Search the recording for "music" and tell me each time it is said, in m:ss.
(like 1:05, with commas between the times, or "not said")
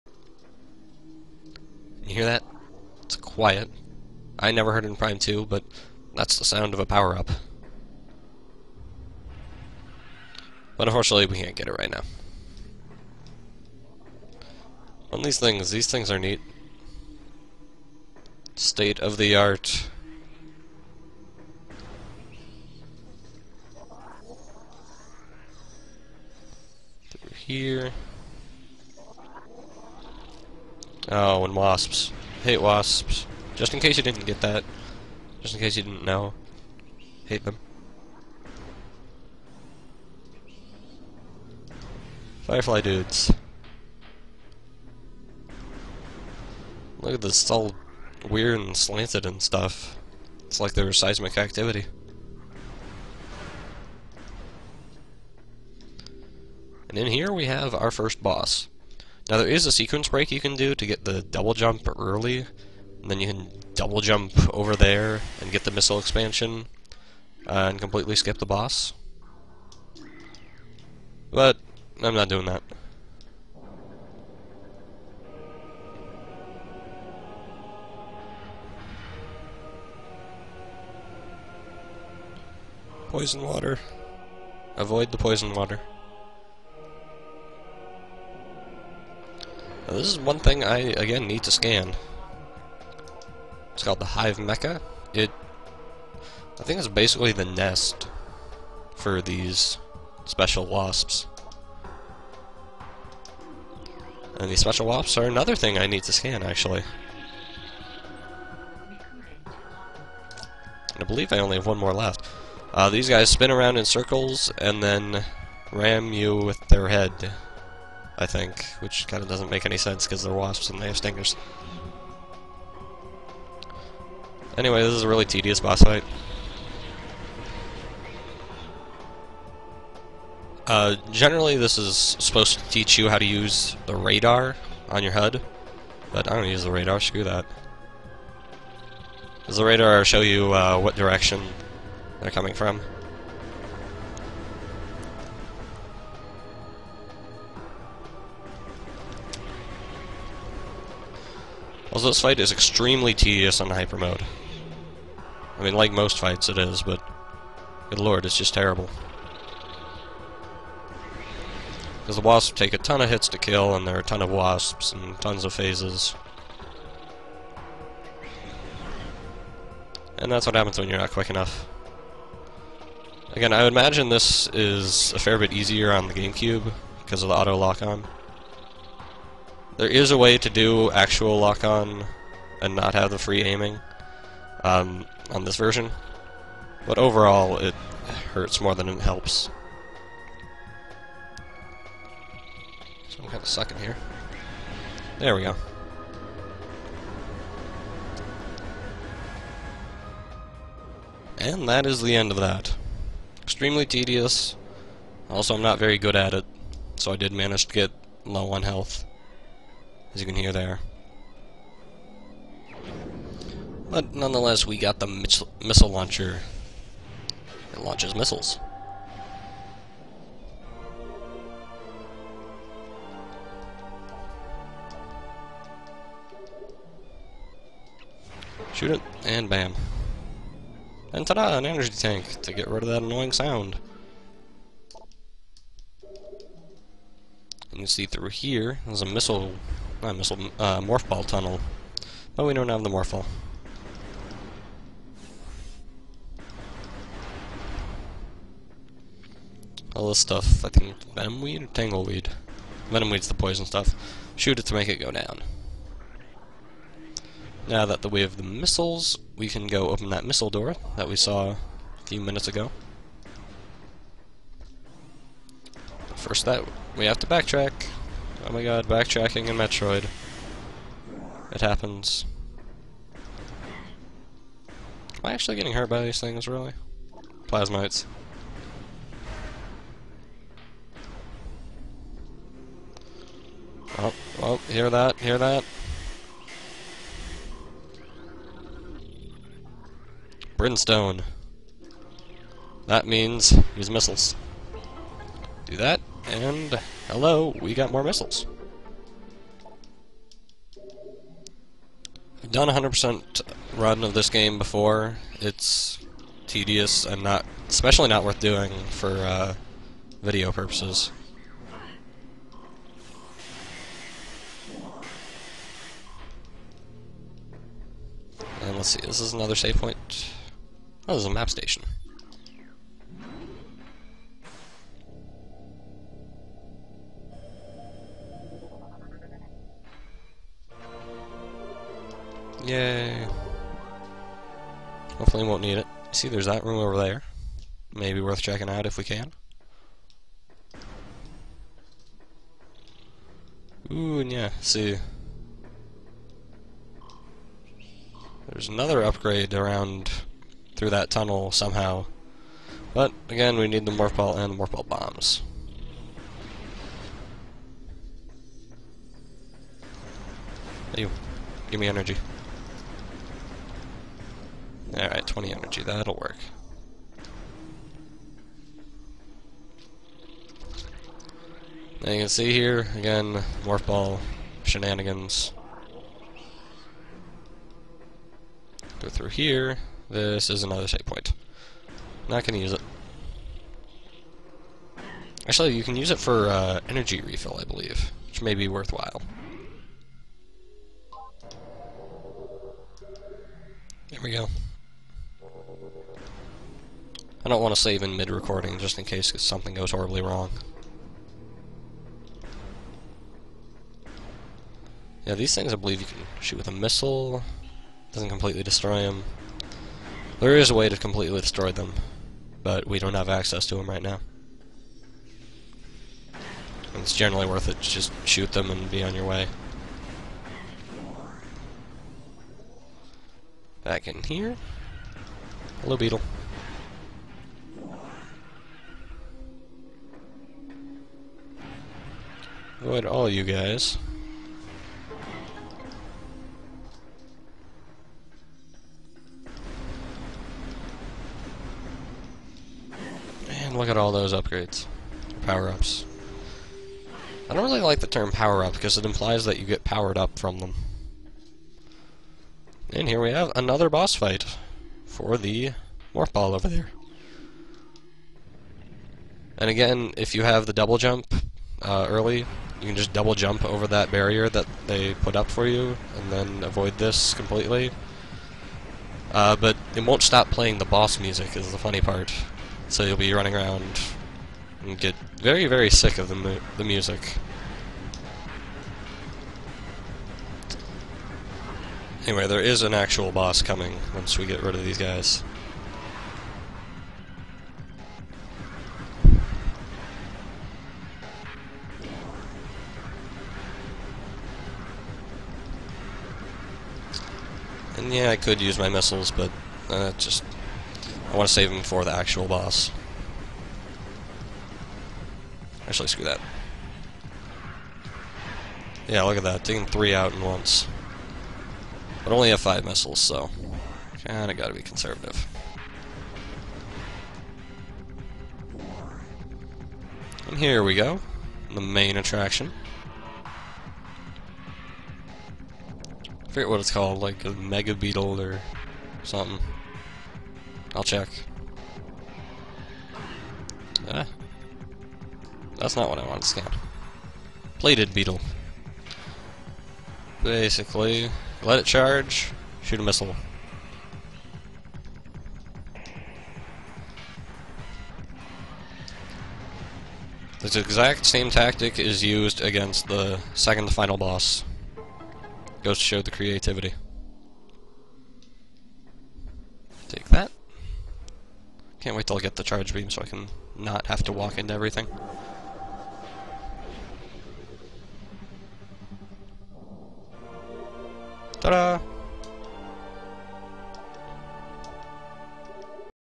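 7:51, 7:56.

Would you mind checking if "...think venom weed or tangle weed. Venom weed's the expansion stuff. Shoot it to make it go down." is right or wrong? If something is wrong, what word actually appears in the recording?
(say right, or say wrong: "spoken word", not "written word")
wrong: "poison", not "expansion".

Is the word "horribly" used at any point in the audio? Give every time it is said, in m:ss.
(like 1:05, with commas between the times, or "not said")
6:39.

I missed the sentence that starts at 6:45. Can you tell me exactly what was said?
Yeah, these things I believe you can shoot with a missile.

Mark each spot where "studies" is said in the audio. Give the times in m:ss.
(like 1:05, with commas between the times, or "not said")
not said.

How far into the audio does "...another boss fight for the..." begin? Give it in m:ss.
7:33.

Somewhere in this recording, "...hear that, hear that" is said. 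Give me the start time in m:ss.
4:44.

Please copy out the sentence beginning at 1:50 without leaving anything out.
And I believe I only have one more left.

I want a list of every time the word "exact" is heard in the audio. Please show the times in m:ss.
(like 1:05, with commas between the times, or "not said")
9:10.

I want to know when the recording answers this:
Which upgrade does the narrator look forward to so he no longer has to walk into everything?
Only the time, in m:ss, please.
9:22.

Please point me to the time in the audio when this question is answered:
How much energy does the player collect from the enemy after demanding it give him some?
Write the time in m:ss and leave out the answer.
6:05.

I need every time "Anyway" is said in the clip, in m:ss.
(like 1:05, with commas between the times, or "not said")
2:04, 8:02.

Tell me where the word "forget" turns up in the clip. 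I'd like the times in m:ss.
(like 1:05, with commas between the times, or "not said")
8:46.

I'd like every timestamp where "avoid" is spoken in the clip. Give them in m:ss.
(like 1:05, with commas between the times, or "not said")
1:24, 7:12, 7:46.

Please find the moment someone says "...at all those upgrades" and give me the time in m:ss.
7:23.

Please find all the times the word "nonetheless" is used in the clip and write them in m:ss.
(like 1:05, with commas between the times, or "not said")
3:34.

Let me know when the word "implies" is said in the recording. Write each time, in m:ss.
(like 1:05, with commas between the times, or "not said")
7:29.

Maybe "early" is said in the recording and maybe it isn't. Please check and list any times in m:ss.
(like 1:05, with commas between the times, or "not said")
1:01, 7:42.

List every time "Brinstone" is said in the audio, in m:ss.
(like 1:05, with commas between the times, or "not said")
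4:50.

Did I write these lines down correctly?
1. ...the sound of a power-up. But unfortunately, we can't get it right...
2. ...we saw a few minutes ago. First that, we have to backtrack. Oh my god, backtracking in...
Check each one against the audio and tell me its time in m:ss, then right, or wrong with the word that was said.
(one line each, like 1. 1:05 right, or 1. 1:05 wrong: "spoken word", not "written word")
1. 0:06 right
2. 4:21 right.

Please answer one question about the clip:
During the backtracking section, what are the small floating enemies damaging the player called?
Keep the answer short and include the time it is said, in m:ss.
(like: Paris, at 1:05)
Plazmites, at 4:37.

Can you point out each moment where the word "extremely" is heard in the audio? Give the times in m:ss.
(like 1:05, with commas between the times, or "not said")
2:32, 3:23.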